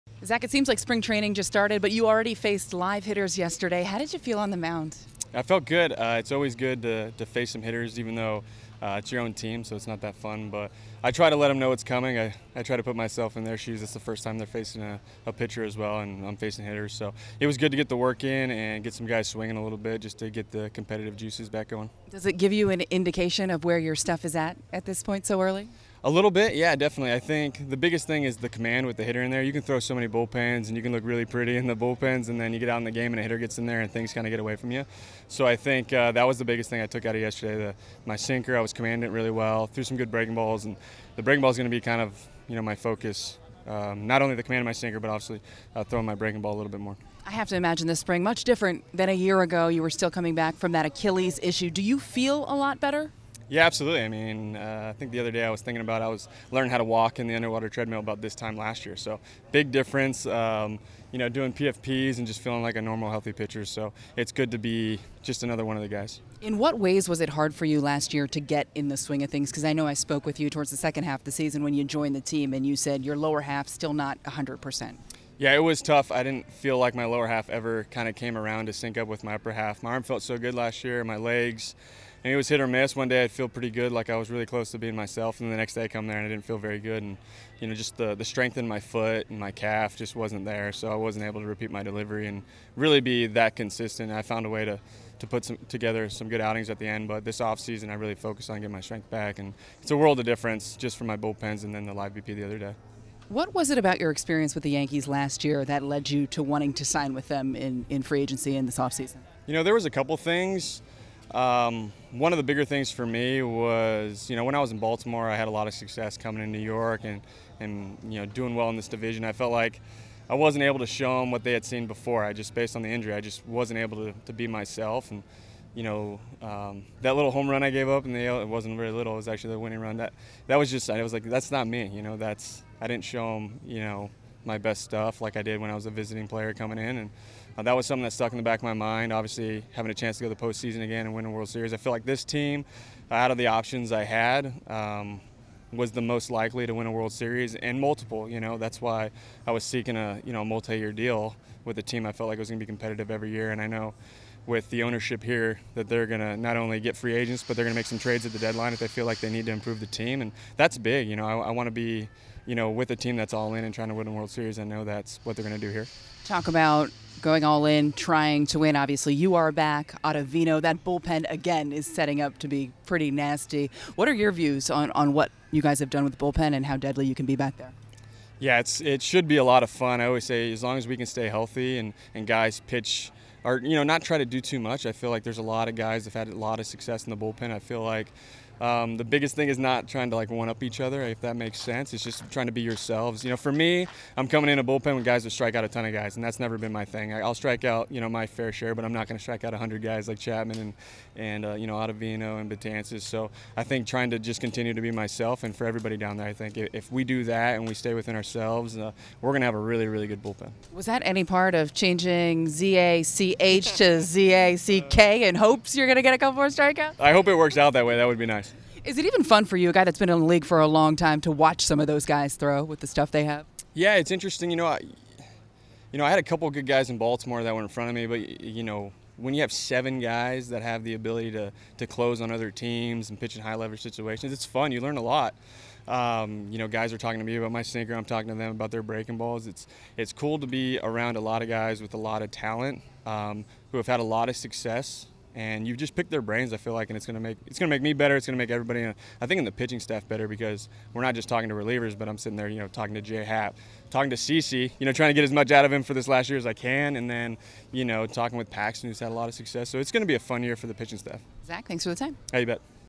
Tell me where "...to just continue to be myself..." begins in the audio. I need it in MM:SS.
03:24.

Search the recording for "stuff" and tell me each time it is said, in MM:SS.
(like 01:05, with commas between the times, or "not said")
00:23, 02:14, 03:42.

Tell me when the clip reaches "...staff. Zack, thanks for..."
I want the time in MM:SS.
04:20.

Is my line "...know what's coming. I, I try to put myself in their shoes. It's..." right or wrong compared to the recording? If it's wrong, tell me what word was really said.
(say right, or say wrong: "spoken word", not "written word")
right.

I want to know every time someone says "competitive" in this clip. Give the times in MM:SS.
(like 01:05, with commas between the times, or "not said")
00:20, 02:32.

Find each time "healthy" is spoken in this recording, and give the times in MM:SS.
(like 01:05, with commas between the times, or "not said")
01:03, 03:01.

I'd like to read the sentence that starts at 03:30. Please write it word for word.
Was that any part of changing ZACH to ZACK in hopes you're going to get a couple more strikeouts?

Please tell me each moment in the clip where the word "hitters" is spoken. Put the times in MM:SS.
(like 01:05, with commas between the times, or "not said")
00:03, 00:07, 00:16, 00:29, 00:33.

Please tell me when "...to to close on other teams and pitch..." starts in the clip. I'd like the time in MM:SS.
03:51.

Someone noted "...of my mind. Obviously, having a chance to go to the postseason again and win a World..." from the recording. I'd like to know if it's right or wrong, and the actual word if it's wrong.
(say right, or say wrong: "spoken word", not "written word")
right.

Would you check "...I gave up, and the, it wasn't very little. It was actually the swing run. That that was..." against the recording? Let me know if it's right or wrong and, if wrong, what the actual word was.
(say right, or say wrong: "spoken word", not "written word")
wrong: "winning", not "swing".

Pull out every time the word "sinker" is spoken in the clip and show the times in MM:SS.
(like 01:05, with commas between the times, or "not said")
00:38, 00:44, 03:57.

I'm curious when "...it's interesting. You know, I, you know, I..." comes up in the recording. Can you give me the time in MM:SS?
03:43.